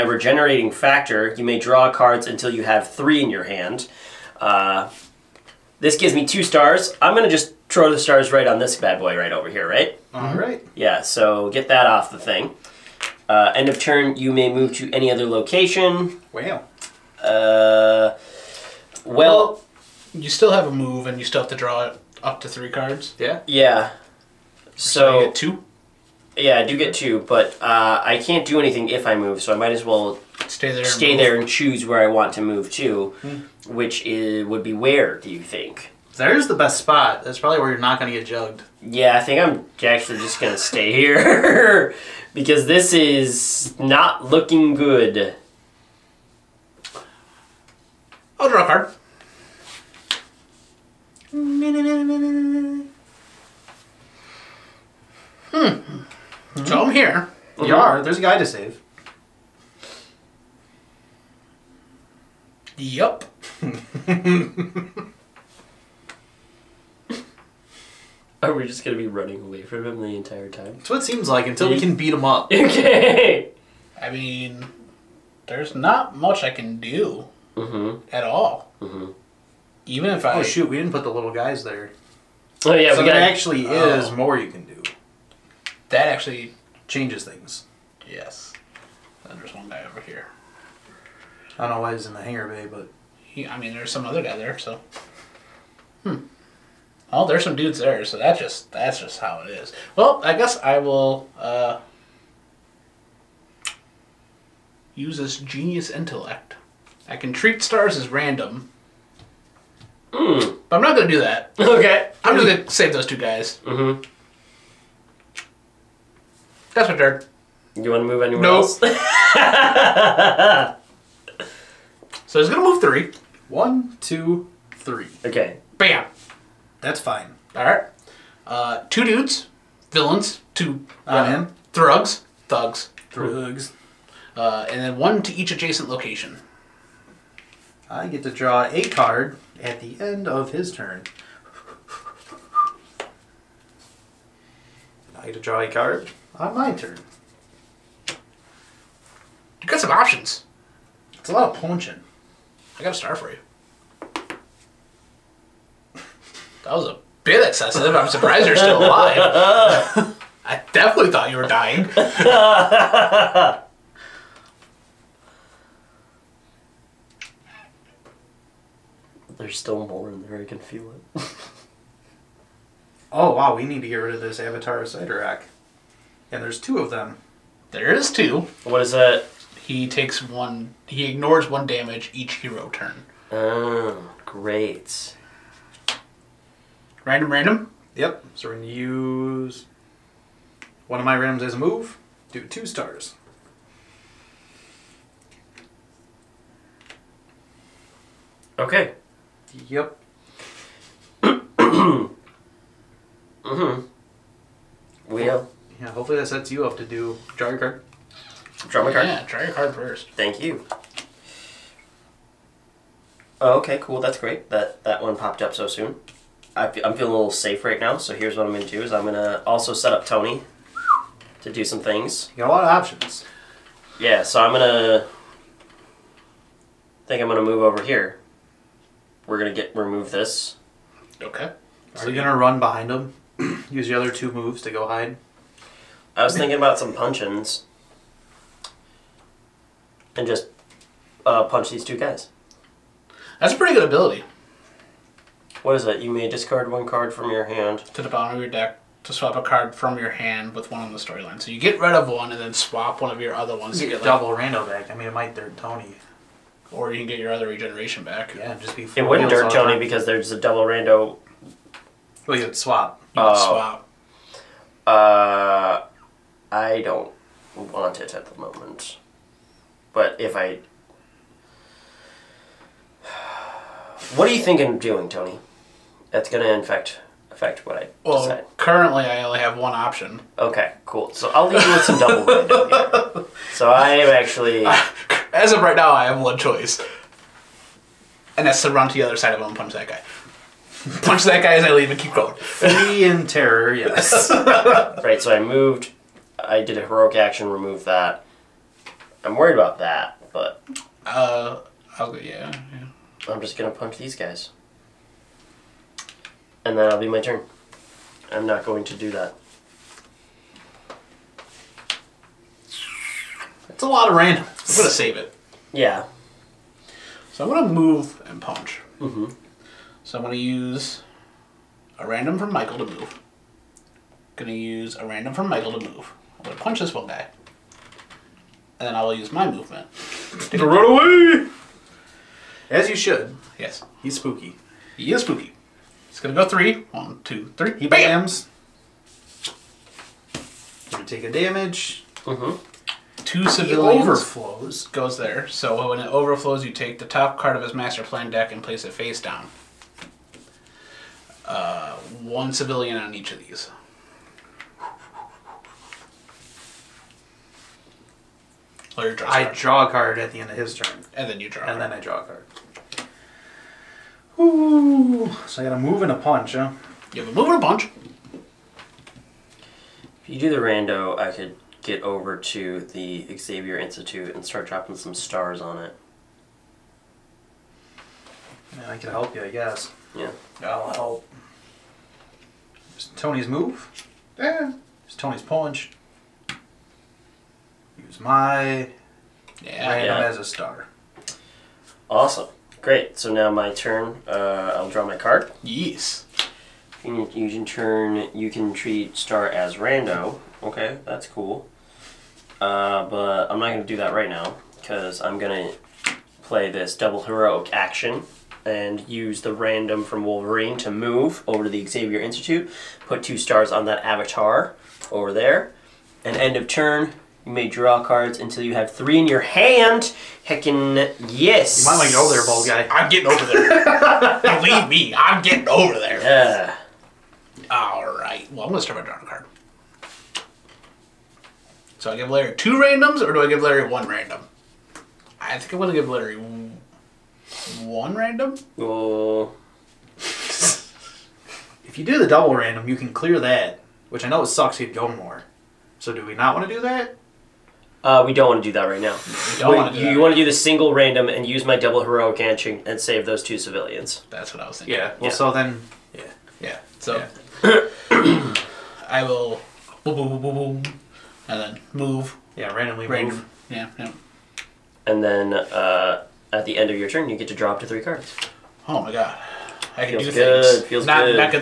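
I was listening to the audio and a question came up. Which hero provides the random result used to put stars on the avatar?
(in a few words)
Wolverine.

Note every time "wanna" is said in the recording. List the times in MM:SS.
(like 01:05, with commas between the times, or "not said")
01:57, 07:29.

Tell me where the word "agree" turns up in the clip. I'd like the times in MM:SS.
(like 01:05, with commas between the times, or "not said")
not said.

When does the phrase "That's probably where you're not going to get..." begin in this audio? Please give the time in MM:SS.
00:37.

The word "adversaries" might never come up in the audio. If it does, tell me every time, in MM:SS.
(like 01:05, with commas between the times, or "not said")
not said.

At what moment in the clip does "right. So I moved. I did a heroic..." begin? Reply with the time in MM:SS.
04:55.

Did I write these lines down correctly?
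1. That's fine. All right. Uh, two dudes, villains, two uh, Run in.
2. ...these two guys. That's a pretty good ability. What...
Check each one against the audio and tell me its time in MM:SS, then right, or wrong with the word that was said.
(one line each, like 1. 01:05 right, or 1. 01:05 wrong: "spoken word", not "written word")
1. 02:06 right
2. 04:01 right.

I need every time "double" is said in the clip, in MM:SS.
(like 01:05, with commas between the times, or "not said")
04:14, 04:20, 04:41, 06:46, 07:22, 07:31.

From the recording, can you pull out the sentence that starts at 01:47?
I can treat stars as random.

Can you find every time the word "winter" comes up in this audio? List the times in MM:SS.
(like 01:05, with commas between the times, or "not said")
not said.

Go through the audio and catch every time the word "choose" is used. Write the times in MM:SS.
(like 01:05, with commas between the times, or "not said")
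00:31, 06:28.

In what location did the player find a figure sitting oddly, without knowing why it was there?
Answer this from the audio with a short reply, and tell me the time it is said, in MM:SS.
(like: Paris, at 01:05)
hangar bay, at 01:32.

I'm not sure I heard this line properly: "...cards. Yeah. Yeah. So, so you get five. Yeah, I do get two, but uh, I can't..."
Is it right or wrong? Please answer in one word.
wrong.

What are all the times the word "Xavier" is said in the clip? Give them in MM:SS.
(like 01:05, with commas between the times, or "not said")
06:13, 06:51.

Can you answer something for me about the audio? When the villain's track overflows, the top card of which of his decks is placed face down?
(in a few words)
master plan deck.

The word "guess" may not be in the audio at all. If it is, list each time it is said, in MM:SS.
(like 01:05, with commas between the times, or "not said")
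01:40, 06:19.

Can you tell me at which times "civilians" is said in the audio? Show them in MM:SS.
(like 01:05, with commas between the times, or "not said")
05:43, 05:52, 07:33.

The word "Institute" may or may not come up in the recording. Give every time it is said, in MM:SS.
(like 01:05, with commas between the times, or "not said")
06:13, 06:52.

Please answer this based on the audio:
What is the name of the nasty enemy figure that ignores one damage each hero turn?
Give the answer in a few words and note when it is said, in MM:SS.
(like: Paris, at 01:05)
Avatar of Rack, at 02:54.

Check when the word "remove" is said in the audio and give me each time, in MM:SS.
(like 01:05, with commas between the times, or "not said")
03:49, 04:57.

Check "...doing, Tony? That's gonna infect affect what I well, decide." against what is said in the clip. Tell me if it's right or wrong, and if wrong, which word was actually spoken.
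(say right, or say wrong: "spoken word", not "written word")
right.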